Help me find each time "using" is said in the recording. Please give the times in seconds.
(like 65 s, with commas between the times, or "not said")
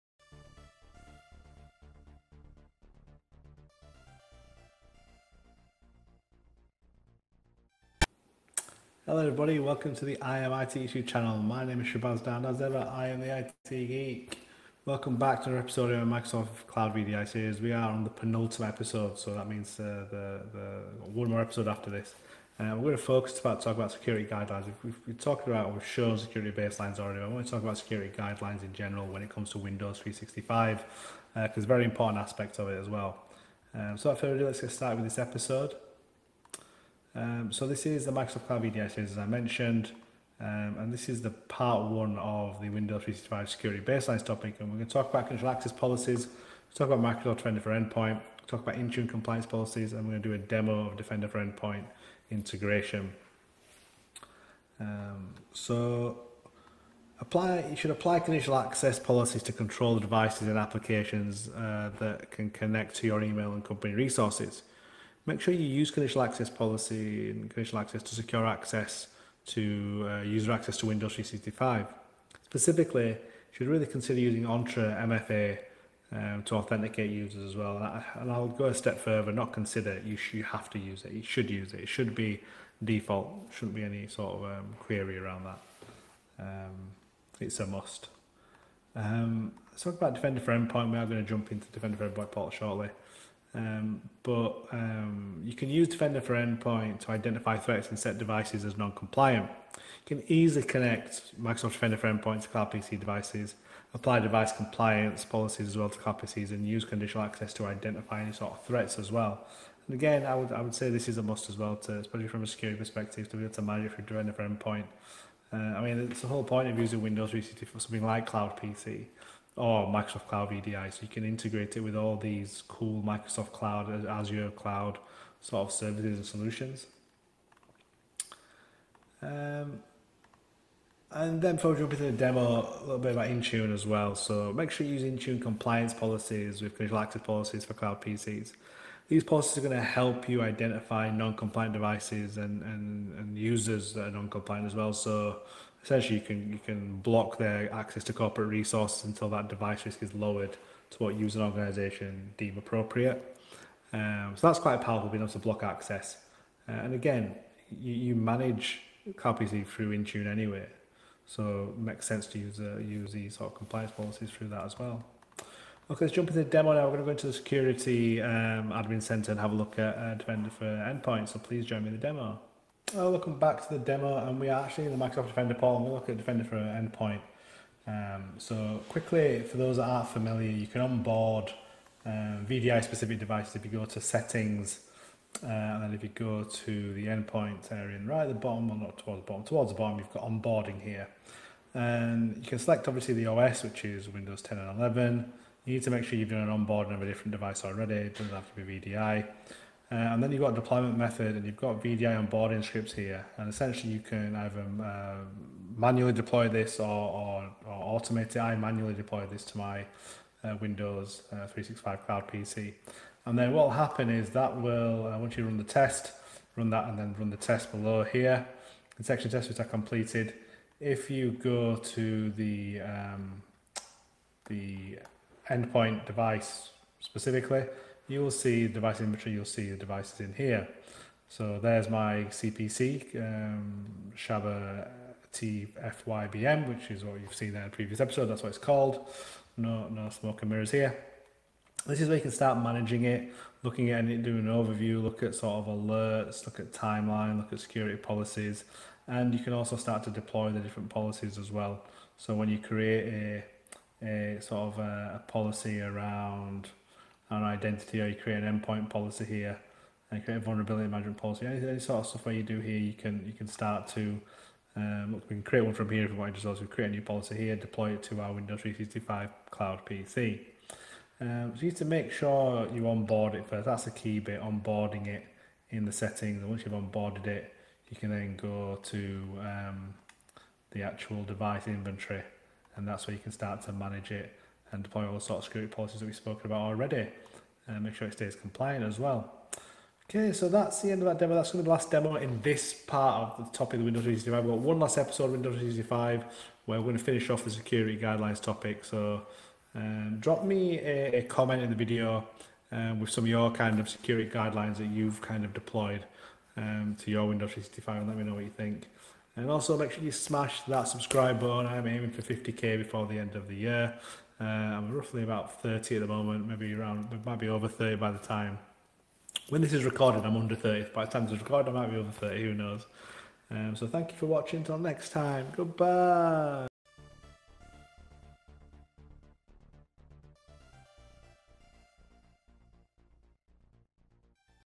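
74 s, 116 s.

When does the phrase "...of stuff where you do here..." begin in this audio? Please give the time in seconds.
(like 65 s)
262 s.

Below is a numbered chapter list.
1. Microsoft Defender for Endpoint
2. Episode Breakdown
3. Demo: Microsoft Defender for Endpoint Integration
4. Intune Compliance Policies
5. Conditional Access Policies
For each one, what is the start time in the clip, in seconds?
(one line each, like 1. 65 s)
1. 88 s
2. 34 s
3. 165 s
4. 129 s
5. 54 s.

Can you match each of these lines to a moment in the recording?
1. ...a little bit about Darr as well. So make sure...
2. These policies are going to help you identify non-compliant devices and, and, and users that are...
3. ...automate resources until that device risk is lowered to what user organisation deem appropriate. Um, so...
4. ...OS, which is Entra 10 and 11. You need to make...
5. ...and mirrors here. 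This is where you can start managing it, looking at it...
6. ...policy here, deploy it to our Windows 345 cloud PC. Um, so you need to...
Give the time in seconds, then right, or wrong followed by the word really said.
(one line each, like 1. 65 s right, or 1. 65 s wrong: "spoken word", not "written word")
1. 132 s wrong: "Intune", not "Darr"
2. 139 s right
3. 148 s wrong: "corporate", not "automate"
4. 193 s wrong: "Windows", not "Entra"
5. 240 s right
6. 267 s wrong: "365", not "345".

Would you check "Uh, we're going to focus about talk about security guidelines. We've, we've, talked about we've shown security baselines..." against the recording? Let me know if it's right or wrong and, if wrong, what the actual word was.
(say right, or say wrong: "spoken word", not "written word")
right.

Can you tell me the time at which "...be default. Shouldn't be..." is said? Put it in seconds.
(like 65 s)
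82 s.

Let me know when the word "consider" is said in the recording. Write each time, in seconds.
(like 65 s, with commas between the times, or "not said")
73 s, 79 s.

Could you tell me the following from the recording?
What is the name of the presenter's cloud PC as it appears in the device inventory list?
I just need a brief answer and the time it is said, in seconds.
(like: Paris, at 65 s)
Shaba TFYBM, at 234 s.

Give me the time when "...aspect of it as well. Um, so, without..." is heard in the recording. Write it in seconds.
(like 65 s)
32 s.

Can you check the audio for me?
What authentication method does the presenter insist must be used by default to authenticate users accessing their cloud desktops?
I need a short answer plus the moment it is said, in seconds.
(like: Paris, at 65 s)
Entra MFA, at 74 s.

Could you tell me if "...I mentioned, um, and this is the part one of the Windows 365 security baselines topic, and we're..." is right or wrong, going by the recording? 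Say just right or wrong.
right.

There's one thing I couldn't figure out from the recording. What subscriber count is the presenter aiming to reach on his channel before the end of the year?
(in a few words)
50k.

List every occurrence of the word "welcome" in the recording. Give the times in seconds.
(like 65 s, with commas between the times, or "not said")
9 s, 14 s, 173 s.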